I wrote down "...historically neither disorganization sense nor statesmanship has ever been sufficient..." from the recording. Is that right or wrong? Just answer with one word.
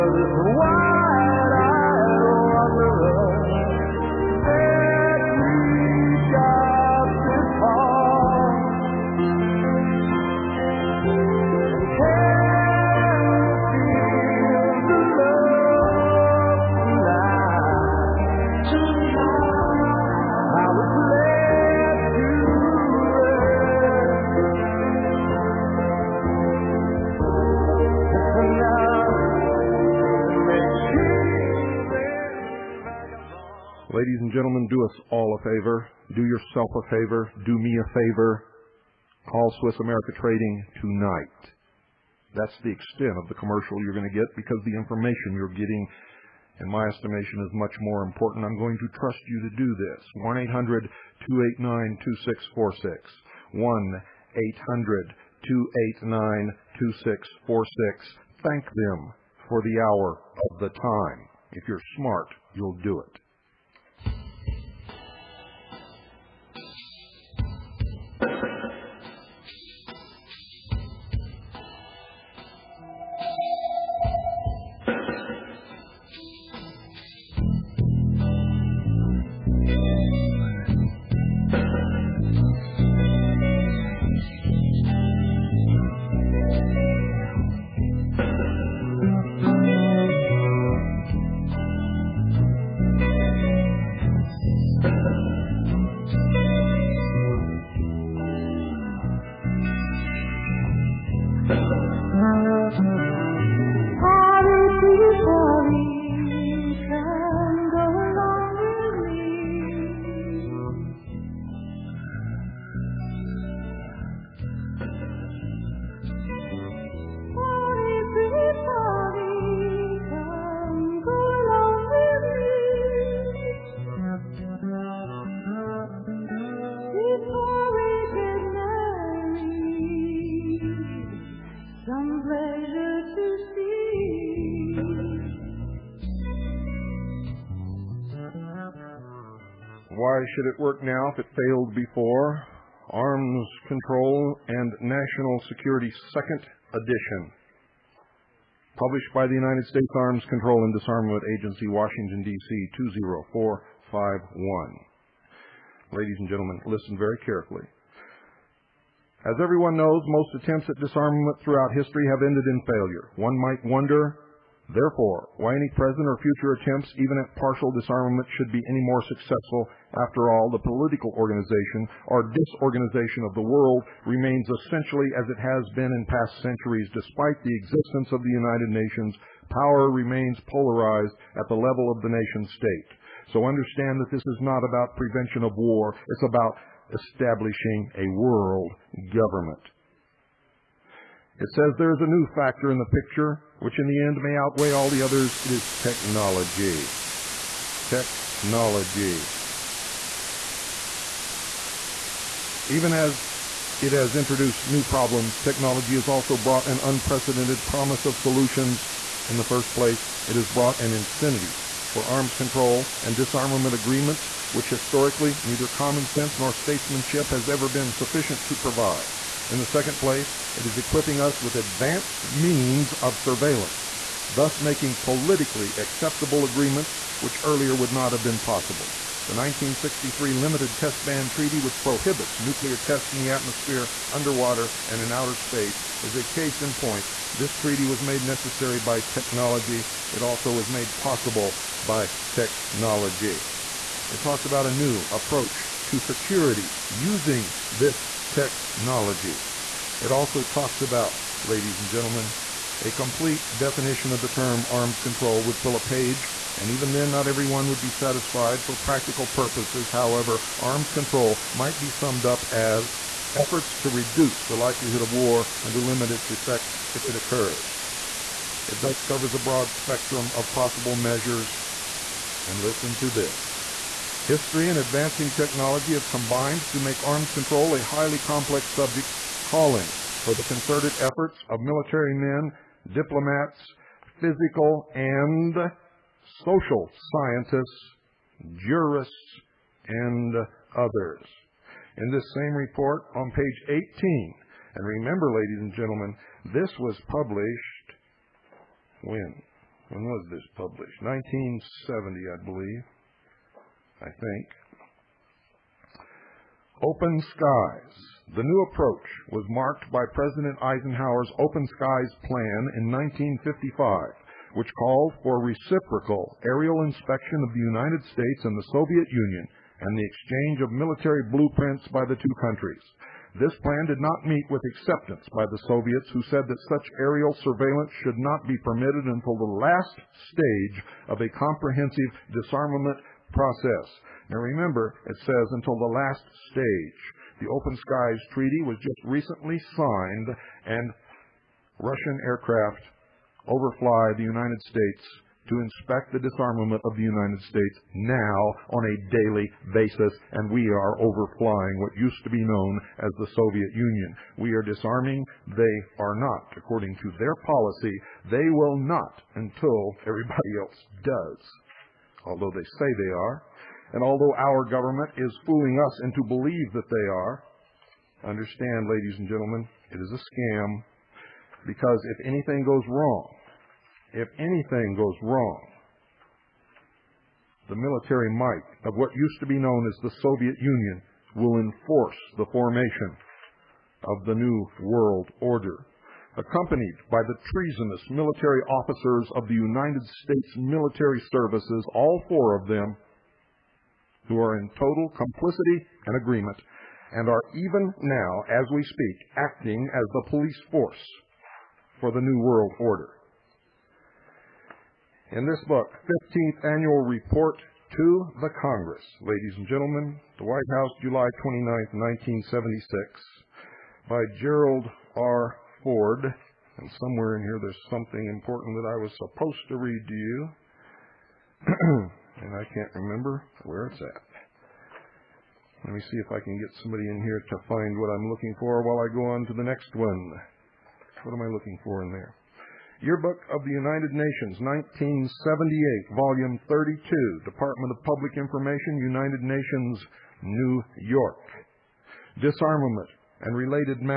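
wrong.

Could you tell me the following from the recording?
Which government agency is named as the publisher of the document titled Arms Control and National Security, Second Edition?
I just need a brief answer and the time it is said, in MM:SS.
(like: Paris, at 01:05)
United States Arms Control and Disarmament Agency, at 02:29.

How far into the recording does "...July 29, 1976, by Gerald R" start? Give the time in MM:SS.
06:51.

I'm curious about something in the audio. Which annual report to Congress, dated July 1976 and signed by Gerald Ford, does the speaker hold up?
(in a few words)
15th Annual Report.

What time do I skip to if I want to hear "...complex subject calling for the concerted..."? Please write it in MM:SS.
04:38.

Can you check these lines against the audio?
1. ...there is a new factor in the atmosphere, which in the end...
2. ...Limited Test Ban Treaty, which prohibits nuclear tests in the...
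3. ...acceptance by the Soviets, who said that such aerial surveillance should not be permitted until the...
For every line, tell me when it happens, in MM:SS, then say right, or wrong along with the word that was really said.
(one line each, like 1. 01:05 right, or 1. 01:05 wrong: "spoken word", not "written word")
1. 03:11 wrong: "picture", not "atmosphere"
2. 03:50 right
3. 05:24 right.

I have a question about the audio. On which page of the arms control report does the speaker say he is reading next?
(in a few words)
18.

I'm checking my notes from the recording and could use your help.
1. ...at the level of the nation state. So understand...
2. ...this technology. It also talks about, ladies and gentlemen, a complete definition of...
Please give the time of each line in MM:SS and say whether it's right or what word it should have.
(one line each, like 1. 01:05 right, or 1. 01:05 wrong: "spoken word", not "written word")
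1. 03:01 right
2. 04:07 right.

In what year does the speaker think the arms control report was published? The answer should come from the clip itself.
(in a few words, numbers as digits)
1970.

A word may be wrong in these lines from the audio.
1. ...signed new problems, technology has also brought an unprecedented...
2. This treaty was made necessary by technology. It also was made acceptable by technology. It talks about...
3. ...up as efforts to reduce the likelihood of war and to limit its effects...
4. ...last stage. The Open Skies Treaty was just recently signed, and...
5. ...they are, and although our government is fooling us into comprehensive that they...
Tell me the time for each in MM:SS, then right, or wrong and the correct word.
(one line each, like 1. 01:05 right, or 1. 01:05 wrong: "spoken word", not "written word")
1. 03:24 wrong: "introduced", not "signed"
2. 03:57 wrong: "possible", not "acceptable"
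3. 04:22 right
4. 05:35 right
5. 06:03 wrong: "believe", not "comprehensive".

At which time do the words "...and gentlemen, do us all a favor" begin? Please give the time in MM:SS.
00:34.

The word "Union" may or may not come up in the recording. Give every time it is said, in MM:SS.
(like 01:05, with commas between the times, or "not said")
05:19, 05:53, 06:20.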